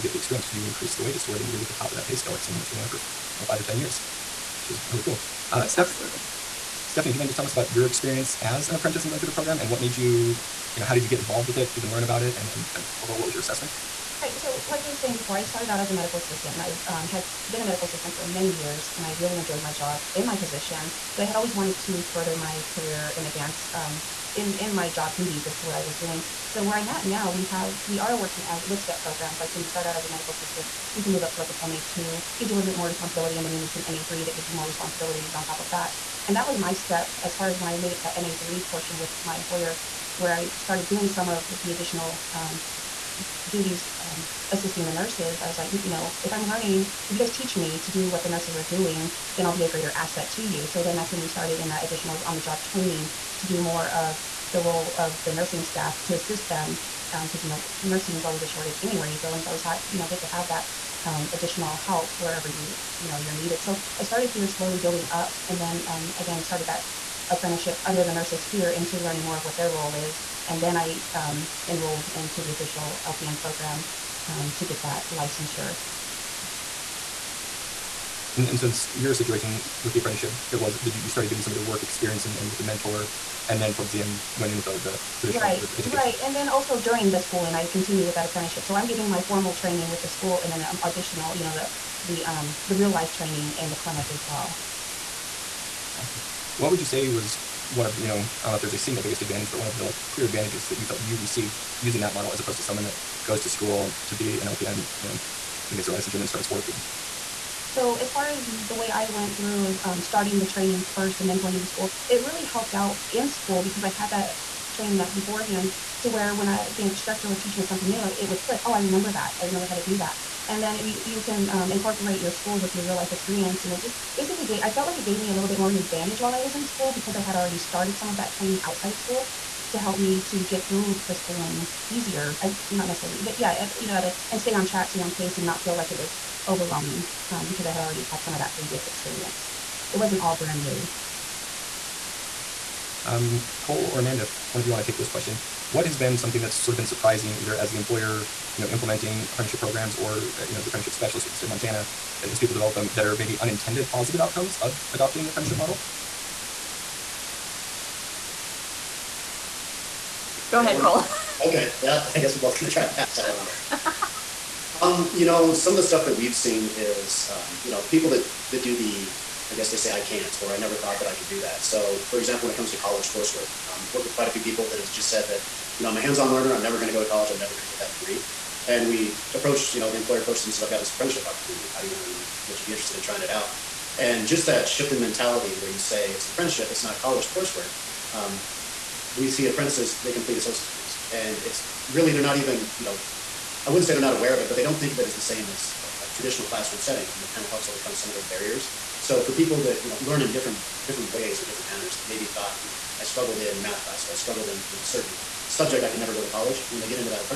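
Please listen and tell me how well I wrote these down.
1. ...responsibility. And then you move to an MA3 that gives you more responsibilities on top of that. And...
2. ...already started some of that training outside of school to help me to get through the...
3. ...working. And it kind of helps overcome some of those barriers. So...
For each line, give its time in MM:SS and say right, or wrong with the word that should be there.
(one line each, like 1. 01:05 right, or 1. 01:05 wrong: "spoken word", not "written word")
1. 00:32 right
2. 02:07 right
3. 03:16 wrong: "setting", not "working".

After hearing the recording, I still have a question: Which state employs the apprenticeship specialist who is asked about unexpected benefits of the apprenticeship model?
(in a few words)
Montana.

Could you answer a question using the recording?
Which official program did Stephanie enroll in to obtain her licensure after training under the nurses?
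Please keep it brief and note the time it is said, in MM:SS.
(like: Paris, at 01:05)
LPN program, at 01:13.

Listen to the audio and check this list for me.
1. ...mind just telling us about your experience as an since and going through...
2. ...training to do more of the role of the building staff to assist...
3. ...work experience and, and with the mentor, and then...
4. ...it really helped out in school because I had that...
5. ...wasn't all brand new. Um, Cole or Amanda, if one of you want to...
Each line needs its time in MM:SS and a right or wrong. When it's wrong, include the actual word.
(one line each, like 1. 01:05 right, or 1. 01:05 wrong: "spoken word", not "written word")
1. 00:07 wrong: "apprentice", not "since"
2. 00:52 wrong: "nursing", not "building"
3. 01:21 right
4. 01:52 right
5. 02:19 right.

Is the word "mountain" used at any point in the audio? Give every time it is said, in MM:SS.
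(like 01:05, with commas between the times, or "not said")
not said.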